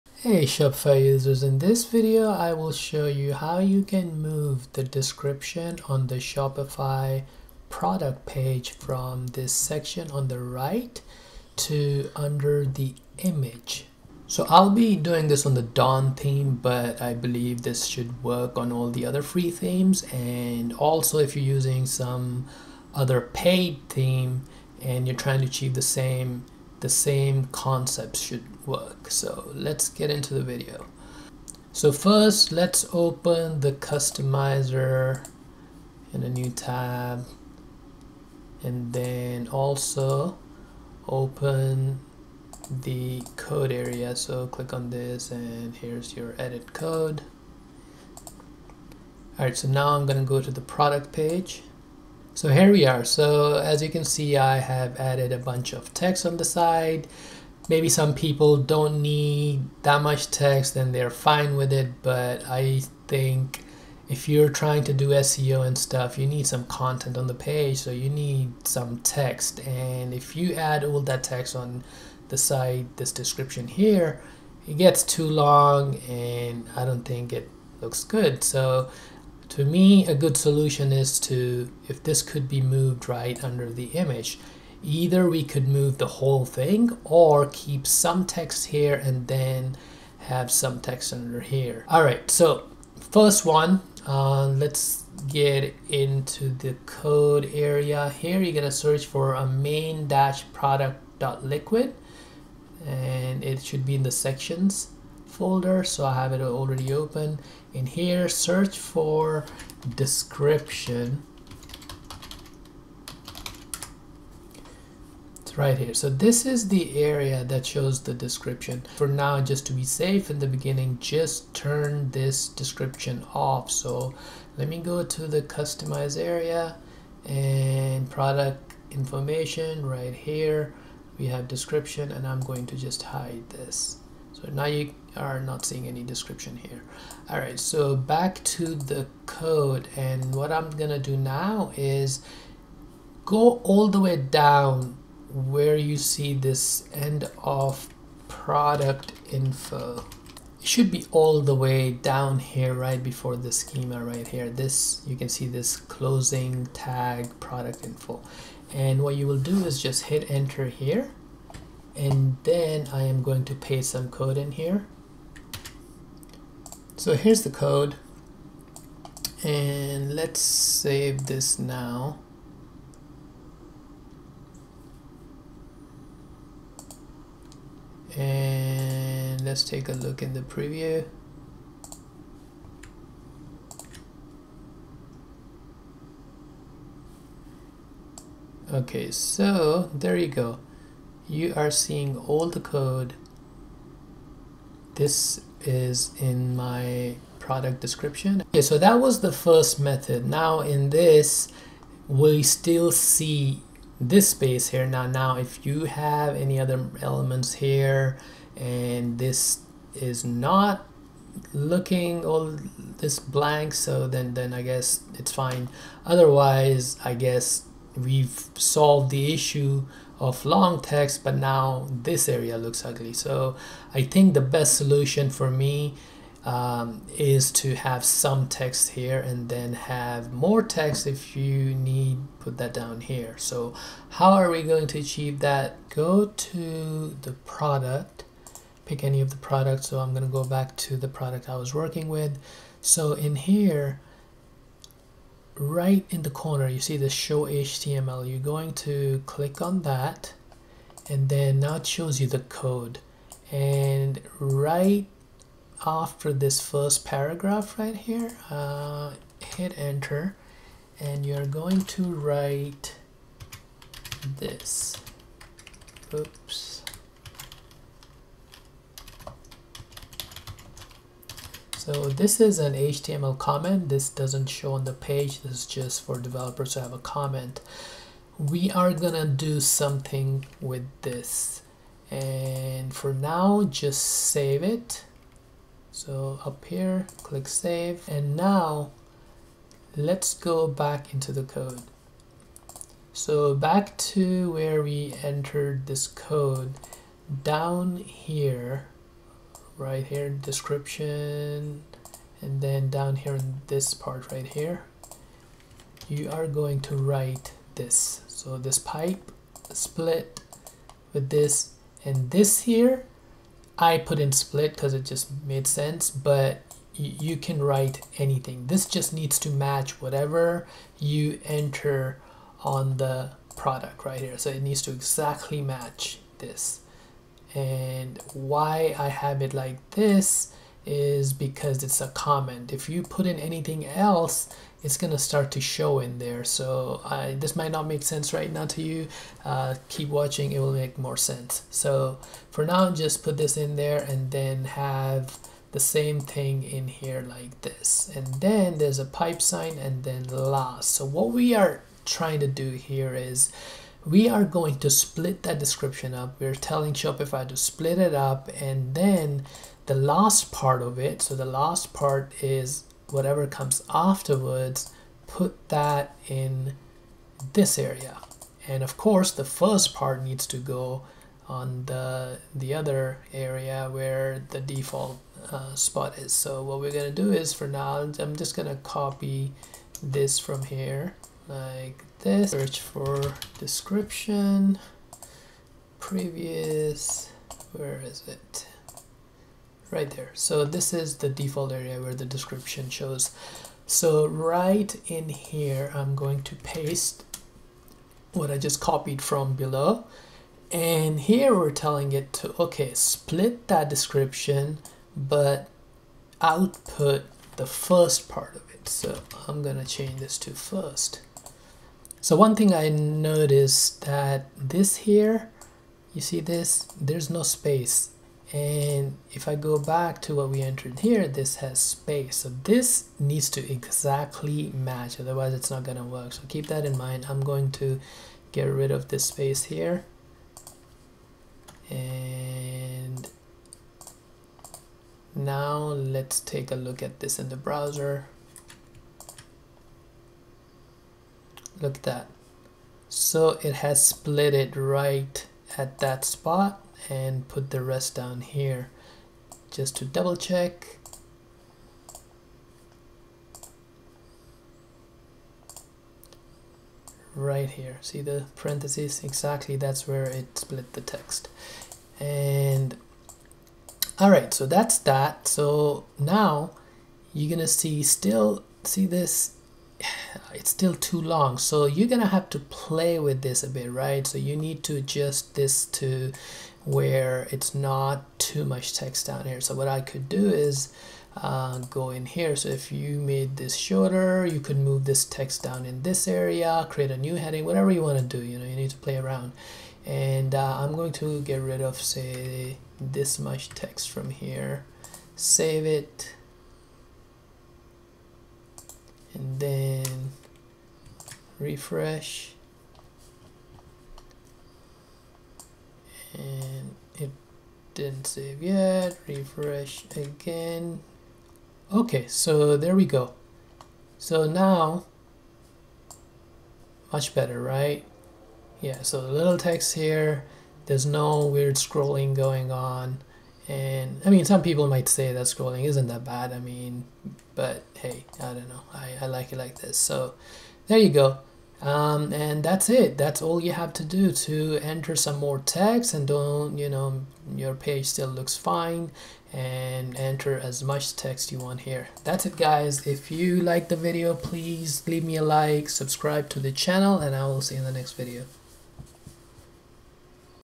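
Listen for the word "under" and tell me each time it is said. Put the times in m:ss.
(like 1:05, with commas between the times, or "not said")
0:12, 1:23, 1:31.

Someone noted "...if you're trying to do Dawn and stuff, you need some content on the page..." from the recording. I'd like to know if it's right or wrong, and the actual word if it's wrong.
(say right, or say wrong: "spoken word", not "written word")
wrong: "SEO", not "Dawn".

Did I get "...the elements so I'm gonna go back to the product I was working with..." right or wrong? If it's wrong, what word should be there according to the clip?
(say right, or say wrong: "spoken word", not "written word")
wrong: "products", not "elements".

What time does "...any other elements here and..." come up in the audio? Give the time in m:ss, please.
3:26.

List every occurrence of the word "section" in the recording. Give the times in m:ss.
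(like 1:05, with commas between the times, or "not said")
0:09, 1:44.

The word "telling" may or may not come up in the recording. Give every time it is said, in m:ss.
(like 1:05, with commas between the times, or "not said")
5:56, 6:41.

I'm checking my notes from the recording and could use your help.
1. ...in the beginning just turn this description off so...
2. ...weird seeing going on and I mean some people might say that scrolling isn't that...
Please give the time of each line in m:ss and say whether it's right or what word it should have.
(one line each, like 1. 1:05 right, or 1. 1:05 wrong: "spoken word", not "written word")
1. 2:00 right
2. 8:41 wrong: "scrolling", not "seeing".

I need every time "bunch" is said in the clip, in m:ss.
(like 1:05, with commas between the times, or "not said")
0:55.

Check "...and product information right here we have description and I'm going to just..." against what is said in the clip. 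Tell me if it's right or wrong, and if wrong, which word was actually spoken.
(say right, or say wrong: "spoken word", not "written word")
right.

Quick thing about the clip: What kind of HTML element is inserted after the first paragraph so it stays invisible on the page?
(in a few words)
HTML comment.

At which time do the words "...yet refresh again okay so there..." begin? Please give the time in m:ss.
8:28.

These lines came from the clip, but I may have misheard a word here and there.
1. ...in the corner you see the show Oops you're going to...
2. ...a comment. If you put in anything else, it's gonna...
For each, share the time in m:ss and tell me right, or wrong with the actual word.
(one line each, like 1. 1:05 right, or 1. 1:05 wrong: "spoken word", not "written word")
1. 4:06 wrong: "HTML", not "Oops"
2. 5:32 right.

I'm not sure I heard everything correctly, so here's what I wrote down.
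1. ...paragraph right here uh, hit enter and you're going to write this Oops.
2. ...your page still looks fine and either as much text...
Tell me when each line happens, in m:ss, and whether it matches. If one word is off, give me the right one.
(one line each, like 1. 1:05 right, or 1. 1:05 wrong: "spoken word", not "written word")
1. 4:17 right
2. 8:57 wrong: "enter", not "either".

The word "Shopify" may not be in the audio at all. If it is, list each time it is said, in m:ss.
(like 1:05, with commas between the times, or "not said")
0:00, 0:06, 5:56.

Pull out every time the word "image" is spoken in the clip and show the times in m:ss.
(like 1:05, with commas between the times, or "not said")
0:13, 1:23.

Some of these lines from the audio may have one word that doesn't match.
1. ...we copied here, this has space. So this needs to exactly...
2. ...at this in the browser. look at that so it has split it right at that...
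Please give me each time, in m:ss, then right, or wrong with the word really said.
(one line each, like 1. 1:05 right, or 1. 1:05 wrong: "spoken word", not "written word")
1. 7:00 wrong: "entered", not "copied"
2. 7:17 right.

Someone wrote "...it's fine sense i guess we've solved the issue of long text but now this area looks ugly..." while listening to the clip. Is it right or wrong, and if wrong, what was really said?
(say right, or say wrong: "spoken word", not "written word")
wrong: "otherwise", not "sense".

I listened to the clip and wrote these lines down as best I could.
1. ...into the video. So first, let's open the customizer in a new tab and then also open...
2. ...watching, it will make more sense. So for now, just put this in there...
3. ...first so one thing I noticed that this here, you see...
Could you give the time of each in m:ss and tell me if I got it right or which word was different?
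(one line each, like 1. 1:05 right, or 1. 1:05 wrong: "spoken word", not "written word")
1. 0:30 right
2. 5:40 right
3. 6:50 right.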